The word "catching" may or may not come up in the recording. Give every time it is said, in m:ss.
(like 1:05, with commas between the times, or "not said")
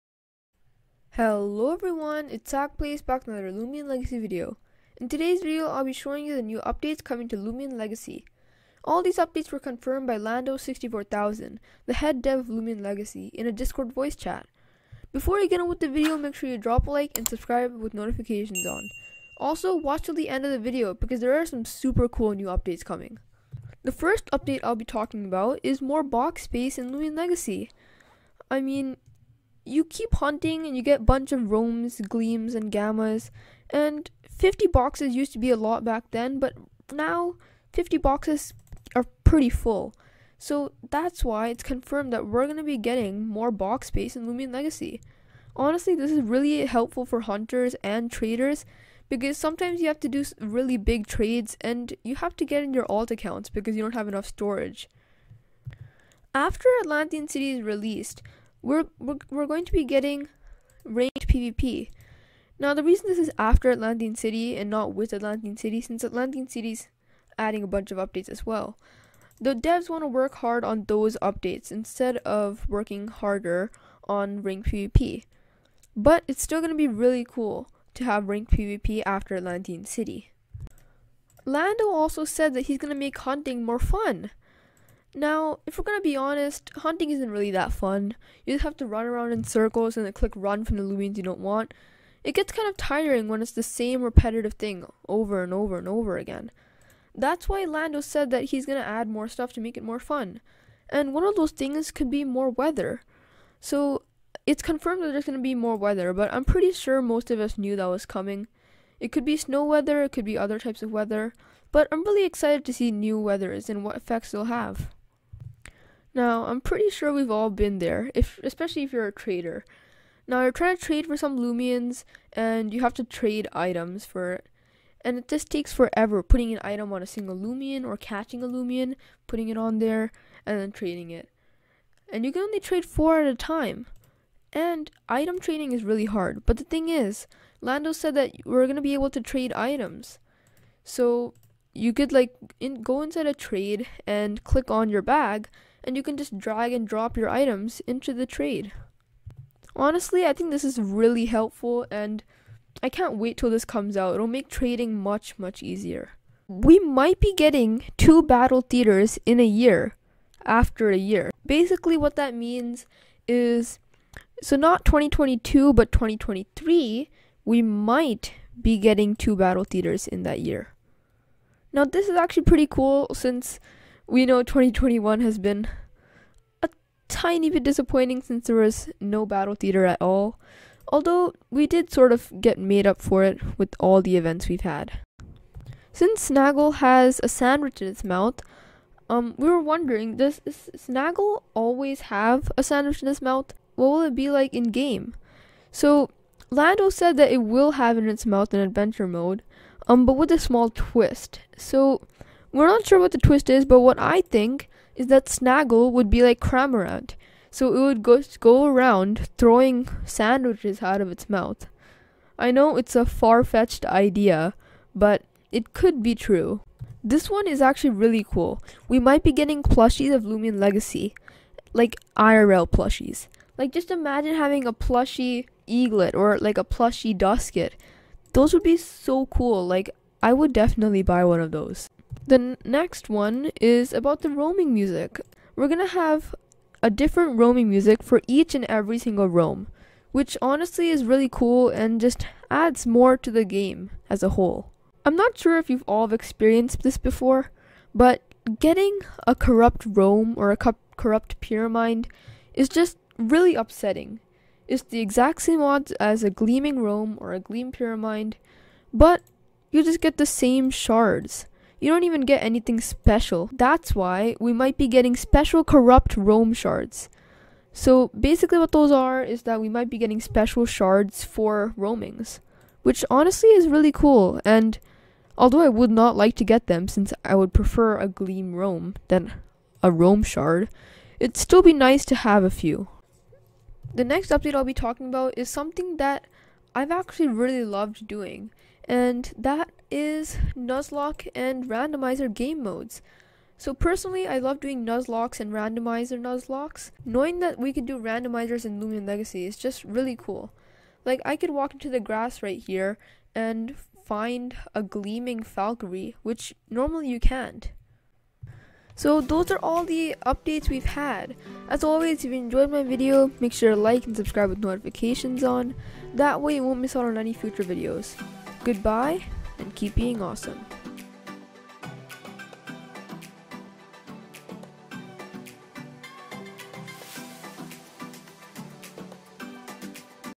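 2:07.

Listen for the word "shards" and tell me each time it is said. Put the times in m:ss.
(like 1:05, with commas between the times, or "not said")
4:20, 4:26, 4:30, 4:40.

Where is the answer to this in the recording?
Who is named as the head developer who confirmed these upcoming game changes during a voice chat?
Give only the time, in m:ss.
0:10.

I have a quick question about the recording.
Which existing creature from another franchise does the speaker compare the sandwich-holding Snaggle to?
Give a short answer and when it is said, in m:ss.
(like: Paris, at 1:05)
Cramorant, at 3:26.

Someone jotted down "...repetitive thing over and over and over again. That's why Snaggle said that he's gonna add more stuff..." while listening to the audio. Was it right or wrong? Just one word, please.
wrong.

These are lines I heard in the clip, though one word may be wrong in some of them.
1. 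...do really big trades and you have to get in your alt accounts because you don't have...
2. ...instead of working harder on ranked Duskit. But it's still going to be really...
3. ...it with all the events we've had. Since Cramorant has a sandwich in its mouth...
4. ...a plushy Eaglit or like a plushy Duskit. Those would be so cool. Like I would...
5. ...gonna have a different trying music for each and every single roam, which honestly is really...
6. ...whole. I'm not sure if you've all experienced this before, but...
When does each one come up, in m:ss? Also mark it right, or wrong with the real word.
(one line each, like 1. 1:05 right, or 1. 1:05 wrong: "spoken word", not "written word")
1. 0:50 right
2. 1:11 wrong: "PvP", not "Duskit"
3. 3:03 wrong: "Snaggle", not "Cramorant"
4. 3:44 right
5. 3:55 wrong: "roaming", not "trying"
6. 4:04 right.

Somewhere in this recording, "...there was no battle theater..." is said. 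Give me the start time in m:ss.
2:58.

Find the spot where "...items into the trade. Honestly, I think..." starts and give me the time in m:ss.
2:27.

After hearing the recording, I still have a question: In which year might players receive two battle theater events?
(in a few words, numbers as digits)
2023.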